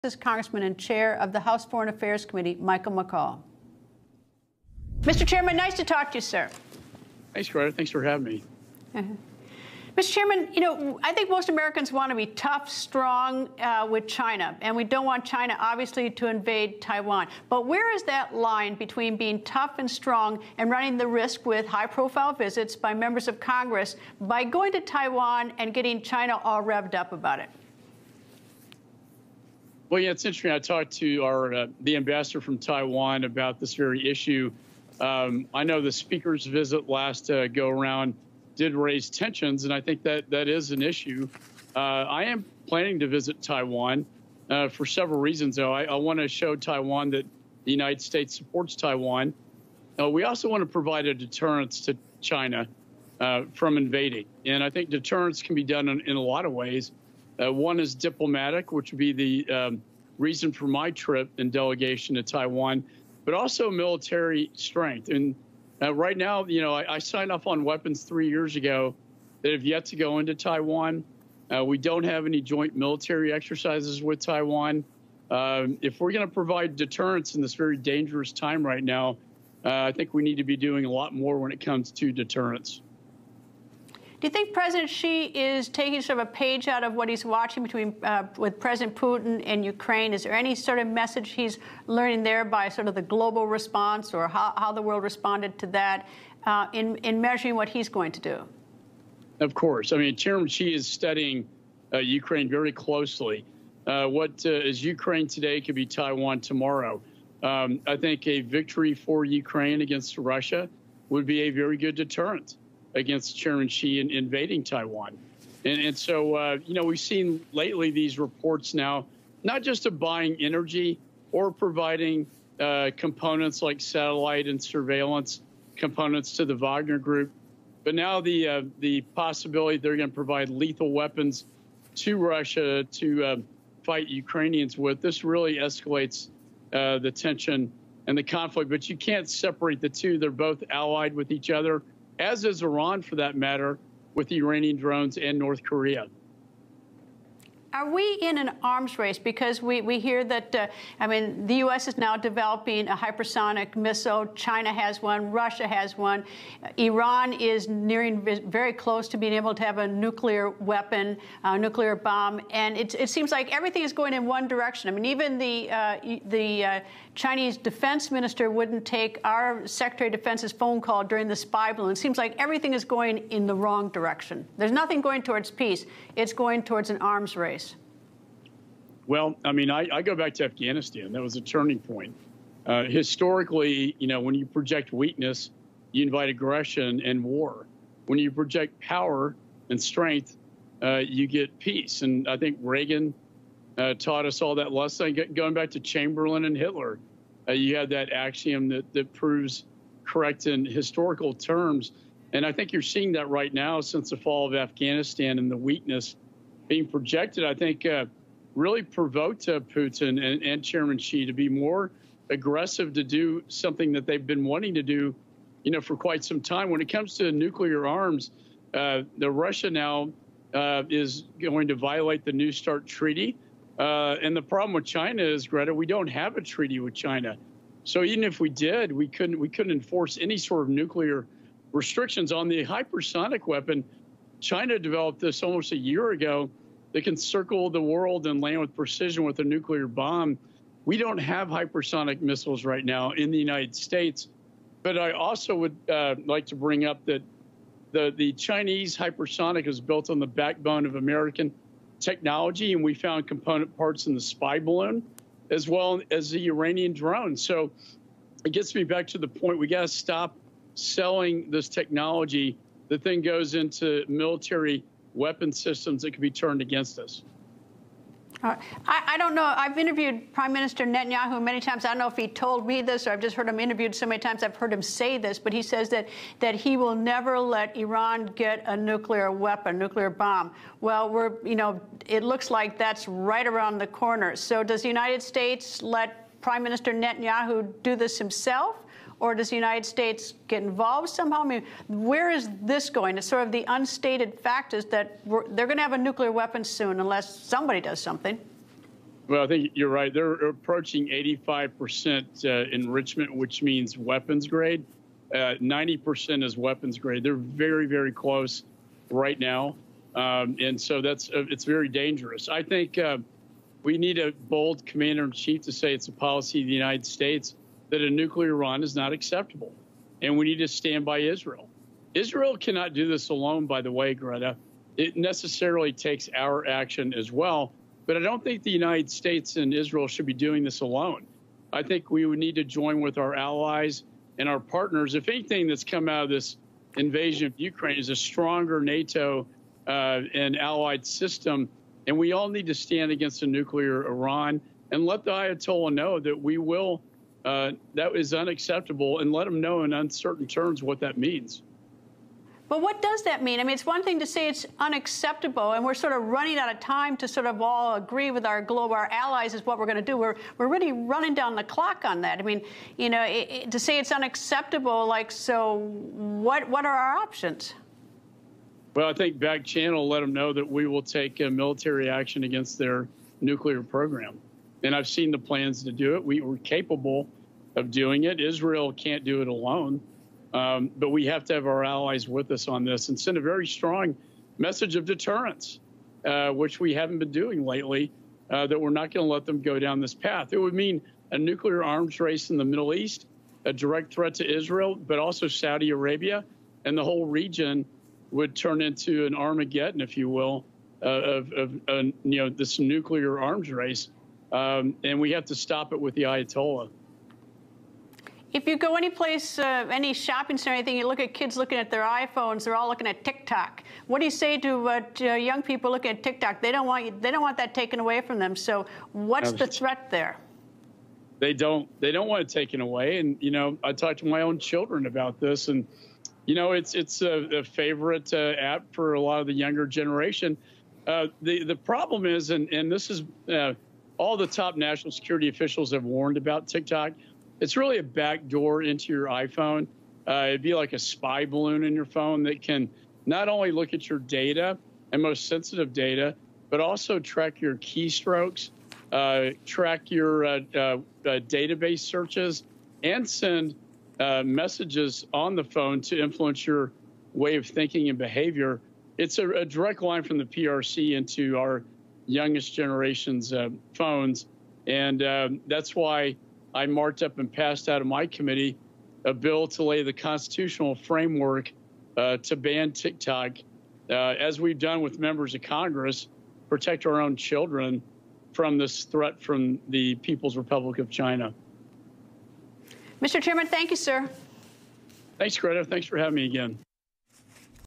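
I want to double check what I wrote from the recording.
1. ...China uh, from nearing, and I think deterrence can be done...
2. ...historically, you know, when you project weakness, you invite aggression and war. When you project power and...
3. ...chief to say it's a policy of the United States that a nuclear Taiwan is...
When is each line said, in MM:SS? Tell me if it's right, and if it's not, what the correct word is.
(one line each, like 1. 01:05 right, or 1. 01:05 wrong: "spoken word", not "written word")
1. 00:52 wrong: "invading", not "nearing"
2. 03:02 right
3. 05:15 wrong: "Iran", not "Taiwan".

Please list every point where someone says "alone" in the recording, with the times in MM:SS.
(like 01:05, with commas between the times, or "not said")
05:23, 05:30, 06:19.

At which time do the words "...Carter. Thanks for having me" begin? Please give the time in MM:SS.
00:07.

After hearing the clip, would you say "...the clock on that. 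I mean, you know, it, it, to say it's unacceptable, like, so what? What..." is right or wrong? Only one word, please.
right.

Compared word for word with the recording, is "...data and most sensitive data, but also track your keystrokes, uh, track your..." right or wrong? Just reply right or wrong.
right.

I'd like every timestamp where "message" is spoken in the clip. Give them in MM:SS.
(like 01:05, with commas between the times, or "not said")
01:30, 06:24, 07:34.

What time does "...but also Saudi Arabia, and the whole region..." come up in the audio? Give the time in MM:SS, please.
06:35.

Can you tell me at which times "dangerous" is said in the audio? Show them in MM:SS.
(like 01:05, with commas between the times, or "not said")
01:17, 05:11.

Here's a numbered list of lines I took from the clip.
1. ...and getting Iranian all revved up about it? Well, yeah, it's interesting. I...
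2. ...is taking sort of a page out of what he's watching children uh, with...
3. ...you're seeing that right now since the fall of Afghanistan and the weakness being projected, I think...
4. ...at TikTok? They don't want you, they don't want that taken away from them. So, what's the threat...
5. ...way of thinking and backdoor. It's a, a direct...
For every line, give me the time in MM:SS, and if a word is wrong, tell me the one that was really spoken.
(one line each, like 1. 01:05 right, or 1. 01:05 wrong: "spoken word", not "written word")
1. 00:25 wrong: "China", not "Iranian"
2. 01:25 wrong: "between", not "children"
3. 03:22 right
4. 06:56 right
5. 07:37 wrong: "behavior", not "backdoor".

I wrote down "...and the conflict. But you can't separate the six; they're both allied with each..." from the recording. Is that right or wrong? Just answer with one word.
wrong.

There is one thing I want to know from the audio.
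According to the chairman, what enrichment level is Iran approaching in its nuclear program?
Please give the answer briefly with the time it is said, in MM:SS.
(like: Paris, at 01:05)
85%, at 05:01.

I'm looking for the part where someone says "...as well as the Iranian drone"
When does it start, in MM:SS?
04:15.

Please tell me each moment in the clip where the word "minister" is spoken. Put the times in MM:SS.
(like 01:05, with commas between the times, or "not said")
02:48, 04:30, 04:46.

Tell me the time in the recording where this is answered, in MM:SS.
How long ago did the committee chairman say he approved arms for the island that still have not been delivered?
01:08.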